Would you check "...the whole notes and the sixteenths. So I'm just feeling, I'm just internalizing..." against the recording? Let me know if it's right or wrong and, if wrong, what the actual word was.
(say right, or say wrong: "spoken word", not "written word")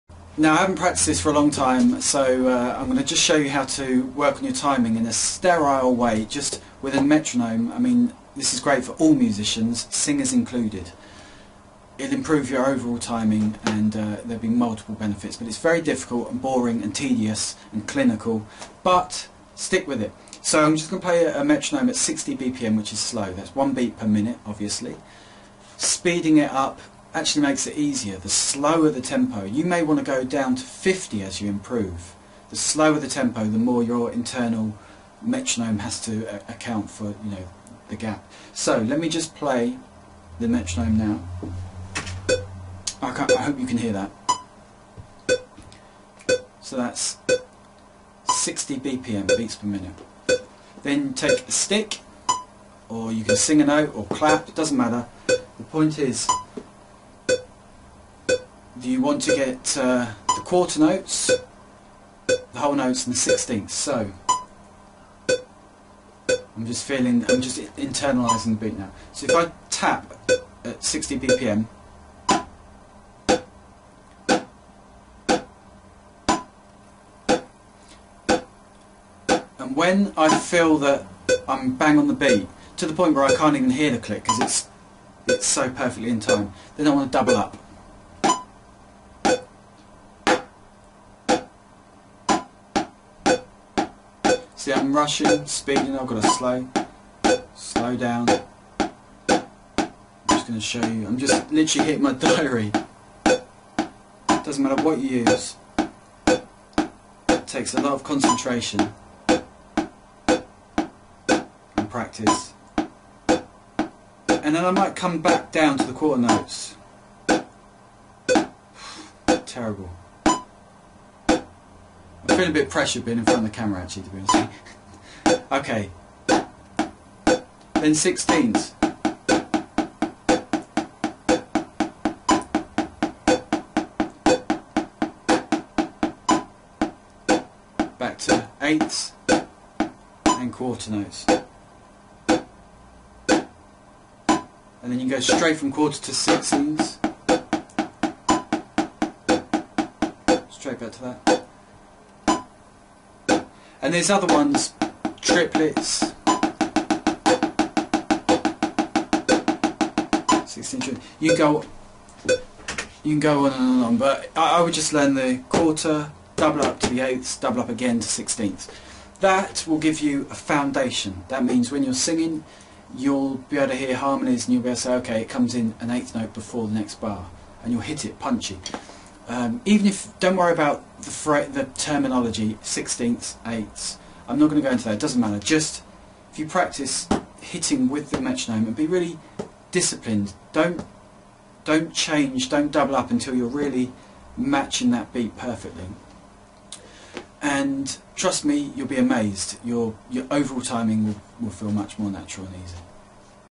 right.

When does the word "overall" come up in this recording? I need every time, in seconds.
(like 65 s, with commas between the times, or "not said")
12 s, 200 s.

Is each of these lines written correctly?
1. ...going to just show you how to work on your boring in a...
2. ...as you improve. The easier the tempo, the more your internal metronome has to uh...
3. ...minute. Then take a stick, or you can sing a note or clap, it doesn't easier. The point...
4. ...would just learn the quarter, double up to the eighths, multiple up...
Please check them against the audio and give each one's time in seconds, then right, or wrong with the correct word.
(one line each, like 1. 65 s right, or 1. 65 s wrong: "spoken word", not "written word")
1. 2 s wrong: "timing", not "boring"
2. 31 s wrong: "slower", not "easier"
3. 49 s wrong: "matter", not "easier"
4. 164 s wrong: "double", not "multiple".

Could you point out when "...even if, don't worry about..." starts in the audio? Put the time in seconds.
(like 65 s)
179 s.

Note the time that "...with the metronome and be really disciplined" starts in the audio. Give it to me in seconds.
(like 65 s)
187 s.